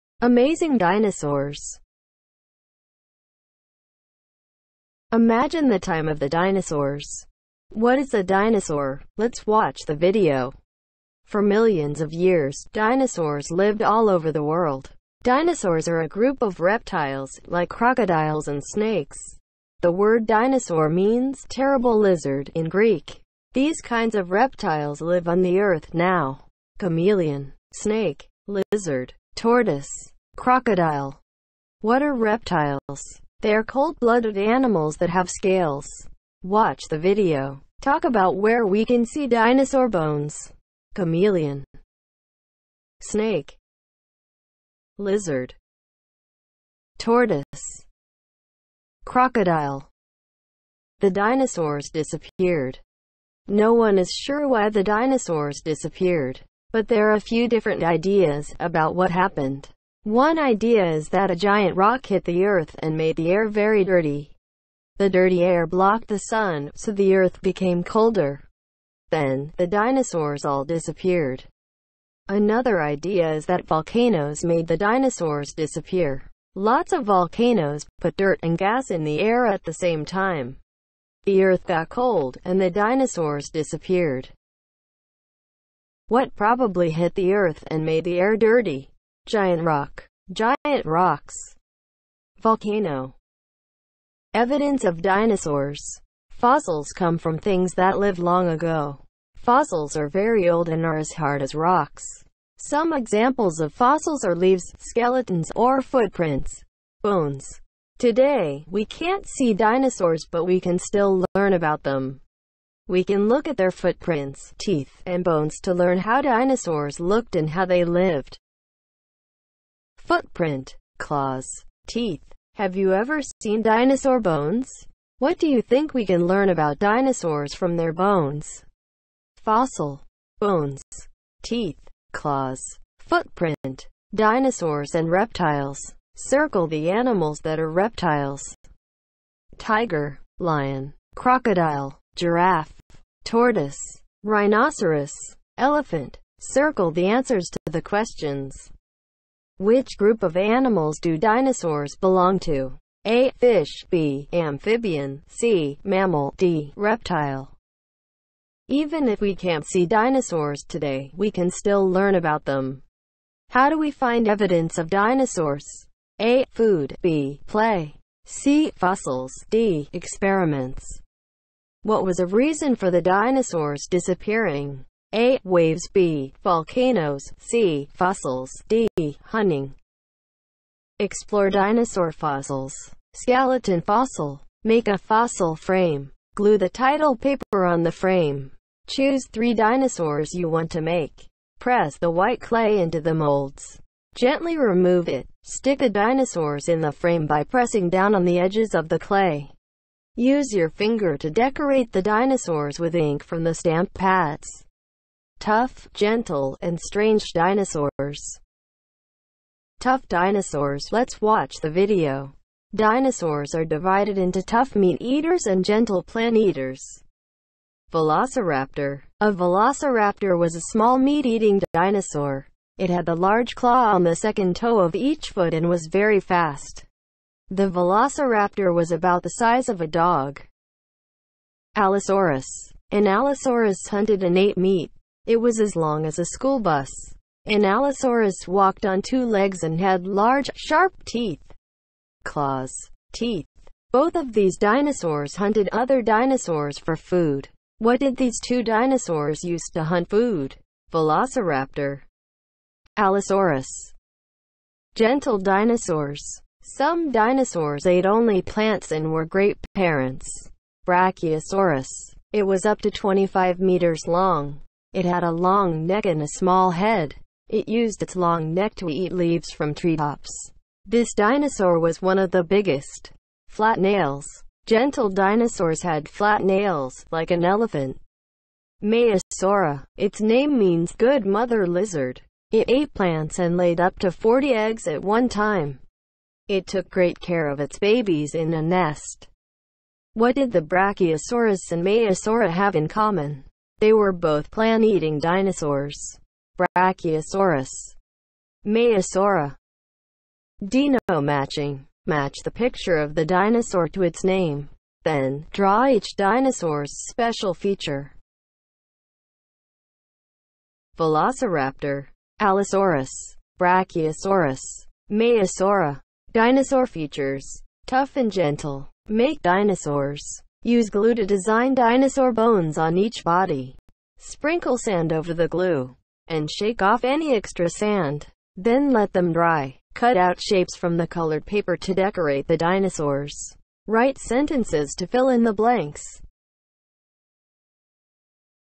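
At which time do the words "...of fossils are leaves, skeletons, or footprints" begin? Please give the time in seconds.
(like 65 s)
103 s.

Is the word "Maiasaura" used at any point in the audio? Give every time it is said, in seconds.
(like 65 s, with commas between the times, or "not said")
278 s, 291 s, 298 s, 315 s.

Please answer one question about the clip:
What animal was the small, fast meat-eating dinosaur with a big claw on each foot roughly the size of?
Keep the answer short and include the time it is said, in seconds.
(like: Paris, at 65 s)
a dog, at 229 s.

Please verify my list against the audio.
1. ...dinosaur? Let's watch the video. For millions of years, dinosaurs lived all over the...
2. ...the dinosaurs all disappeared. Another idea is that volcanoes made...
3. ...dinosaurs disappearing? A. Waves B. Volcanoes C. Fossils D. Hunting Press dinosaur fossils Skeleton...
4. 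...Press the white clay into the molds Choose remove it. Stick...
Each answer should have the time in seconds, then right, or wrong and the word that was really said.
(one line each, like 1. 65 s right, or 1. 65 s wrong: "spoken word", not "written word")
1. 8 s right
2. 69 s right
3. 173 s wrong: "Explore", not "Press"
4. 191 s wrong: "Gently", not "Choose".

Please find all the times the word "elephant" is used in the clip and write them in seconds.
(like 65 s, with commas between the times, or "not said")
145 s, 277 s.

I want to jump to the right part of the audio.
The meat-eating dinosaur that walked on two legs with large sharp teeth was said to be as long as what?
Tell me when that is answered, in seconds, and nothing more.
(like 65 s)
236 s.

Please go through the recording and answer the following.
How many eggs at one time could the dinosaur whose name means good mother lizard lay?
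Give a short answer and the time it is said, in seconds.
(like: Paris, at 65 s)
40, at 284 s.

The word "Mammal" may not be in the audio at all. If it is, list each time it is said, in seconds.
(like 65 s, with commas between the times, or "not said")
155 s.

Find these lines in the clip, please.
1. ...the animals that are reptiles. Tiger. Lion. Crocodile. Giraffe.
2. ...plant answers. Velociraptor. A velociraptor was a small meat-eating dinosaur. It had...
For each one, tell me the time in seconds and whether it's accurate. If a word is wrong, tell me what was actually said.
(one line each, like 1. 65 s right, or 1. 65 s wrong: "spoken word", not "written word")
1. 136 s right
2. 216 s wrong: "eaters", not "answers".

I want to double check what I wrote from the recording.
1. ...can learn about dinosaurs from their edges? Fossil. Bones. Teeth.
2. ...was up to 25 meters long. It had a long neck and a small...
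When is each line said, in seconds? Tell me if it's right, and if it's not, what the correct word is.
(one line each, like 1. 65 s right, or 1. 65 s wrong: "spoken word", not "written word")
1. 126 s wrong: "bones", not "edges"
2. 262 s right.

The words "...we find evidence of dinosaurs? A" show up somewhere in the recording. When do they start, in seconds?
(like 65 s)
163 s.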